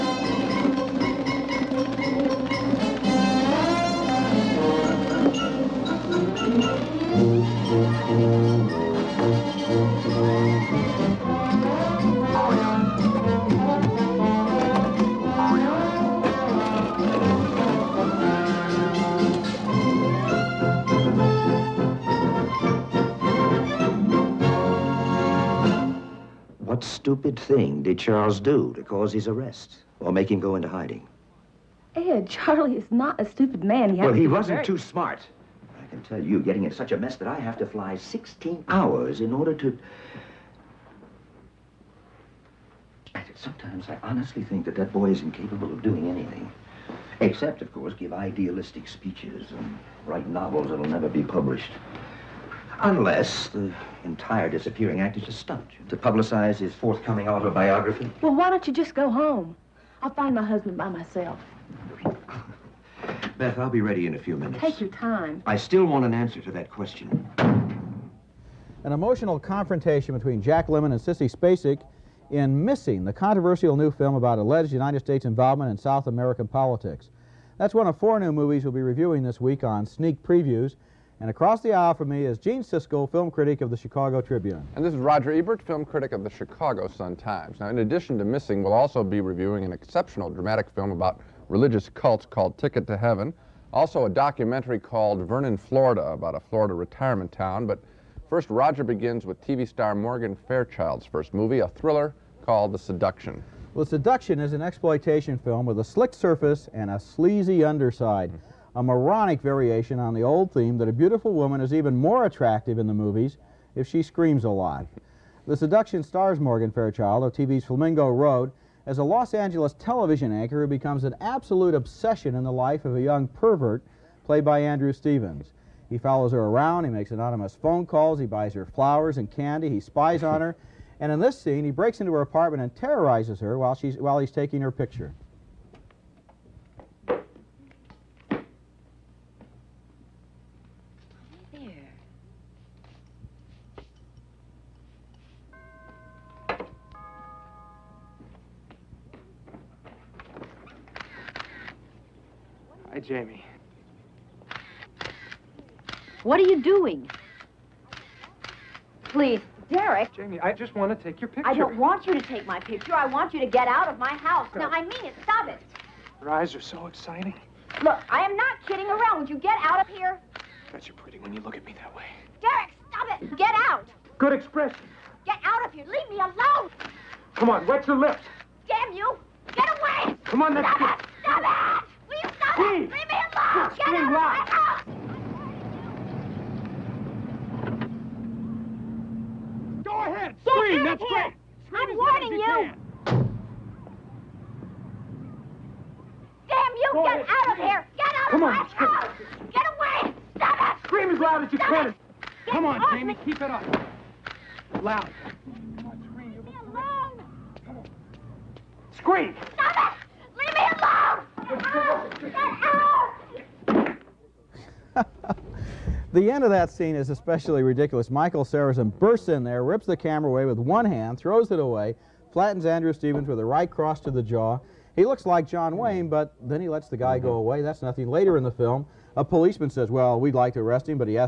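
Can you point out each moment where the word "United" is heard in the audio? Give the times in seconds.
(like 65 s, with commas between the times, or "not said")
74 s.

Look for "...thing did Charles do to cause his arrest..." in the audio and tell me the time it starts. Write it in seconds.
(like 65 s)
27 s.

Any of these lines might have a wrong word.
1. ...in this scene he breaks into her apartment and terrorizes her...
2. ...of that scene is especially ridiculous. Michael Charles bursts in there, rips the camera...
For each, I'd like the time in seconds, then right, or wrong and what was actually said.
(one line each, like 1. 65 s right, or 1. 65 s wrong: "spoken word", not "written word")
1. 131 s right
2. 216 s wrong: "Sarrazin", not "Charles".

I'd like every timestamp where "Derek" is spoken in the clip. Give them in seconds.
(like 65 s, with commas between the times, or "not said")
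159 s, 172 s.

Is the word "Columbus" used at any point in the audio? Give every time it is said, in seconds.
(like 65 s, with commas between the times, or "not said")
not said.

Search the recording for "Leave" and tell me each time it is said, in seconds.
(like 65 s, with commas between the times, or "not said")
175 s, 182 s, 206 s.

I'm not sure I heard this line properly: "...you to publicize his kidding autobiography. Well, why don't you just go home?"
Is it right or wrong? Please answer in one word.
wrong.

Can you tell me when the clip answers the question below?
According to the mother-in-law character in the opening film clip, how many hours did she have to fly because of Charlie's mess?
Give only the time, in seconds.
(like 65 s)
37 s.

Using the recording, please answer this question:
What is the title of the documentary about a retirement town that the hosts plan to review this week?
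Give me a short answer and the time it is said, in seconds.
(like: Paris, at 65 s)
Vernon, Florida, at 95 s.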